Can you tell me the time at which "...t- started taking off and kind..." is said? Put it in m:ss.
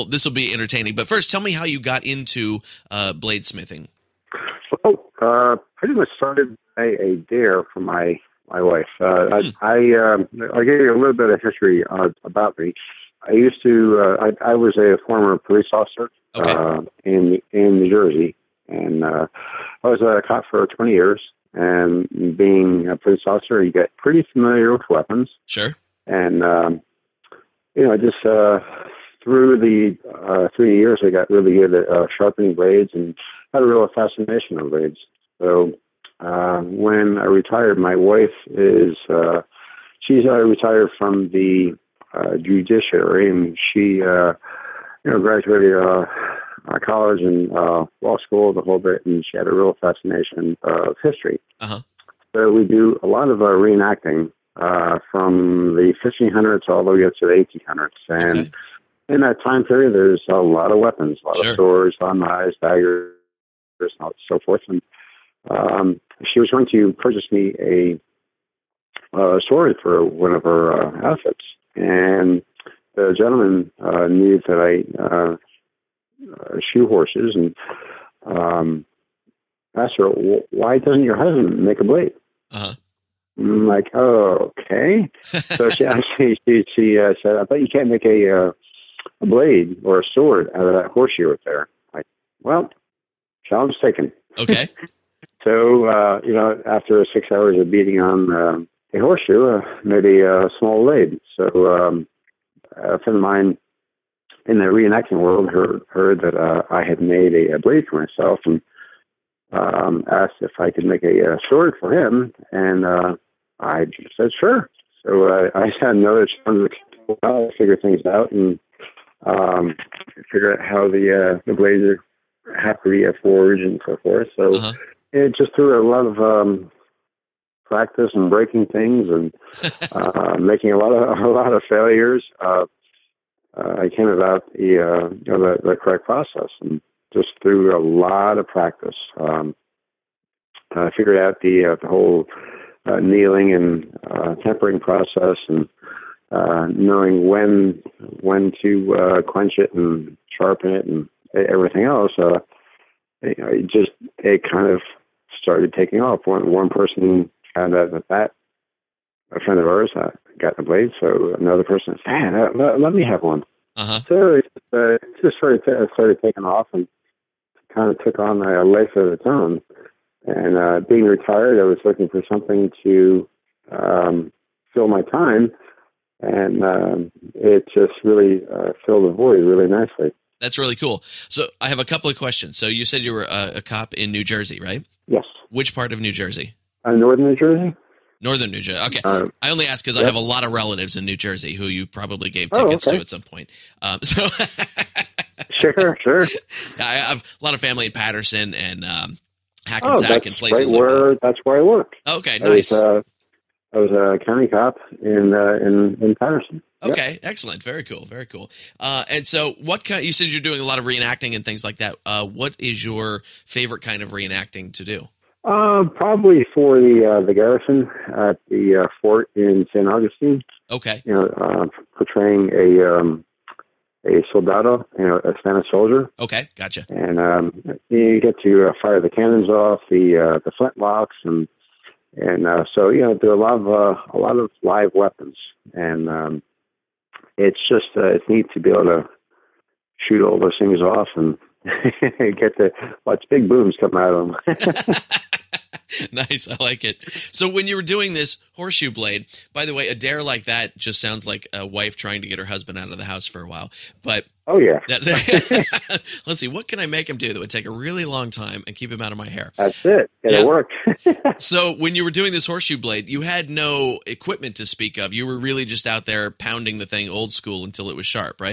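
2:45.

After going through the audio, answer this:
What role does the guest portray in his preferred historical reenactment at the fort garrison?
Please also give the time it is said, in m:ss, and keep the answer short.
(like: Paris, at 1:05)
soldado, at 3:44.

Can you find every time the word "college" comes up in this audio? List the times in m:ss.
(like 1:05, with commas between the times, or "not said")
0:46.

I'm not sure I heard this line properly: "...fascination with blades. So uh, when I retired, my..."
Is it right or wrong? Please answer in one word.
right.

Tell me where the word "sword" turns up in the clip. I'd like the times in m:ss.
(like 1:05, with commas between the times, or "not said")
1:01, 1:09, 1:30, 1:51.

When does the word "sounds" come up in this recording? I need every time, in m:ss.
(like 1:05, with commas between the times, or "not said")
4:11.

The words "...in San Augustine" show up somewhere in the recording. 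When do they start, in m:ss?
3:39.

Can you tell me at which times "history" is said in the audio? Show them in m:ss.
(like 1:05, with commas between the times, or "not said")
0:11, 0:51.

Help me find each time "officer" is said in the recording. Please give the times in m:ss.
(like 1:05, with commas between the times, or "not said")
0:15, 0:23.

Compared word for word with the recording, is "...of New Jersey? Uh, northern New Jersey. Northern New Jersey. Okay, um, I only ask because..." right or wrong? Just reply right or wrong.
right.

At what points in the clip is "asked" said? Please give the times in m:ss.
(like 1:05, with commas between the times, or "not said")
1:19, 1:50.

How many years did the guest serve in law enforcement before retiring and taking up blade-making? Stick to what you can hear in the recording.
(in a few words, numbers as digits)
20.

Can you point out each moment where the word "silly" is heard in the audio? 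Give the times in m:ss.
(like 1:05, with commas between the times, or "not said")
not said.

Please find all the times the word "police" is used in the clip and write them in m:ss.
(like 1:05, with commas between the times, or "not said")
0:15, 0:22.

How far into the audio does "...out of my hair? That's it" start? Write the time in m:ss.
4:19.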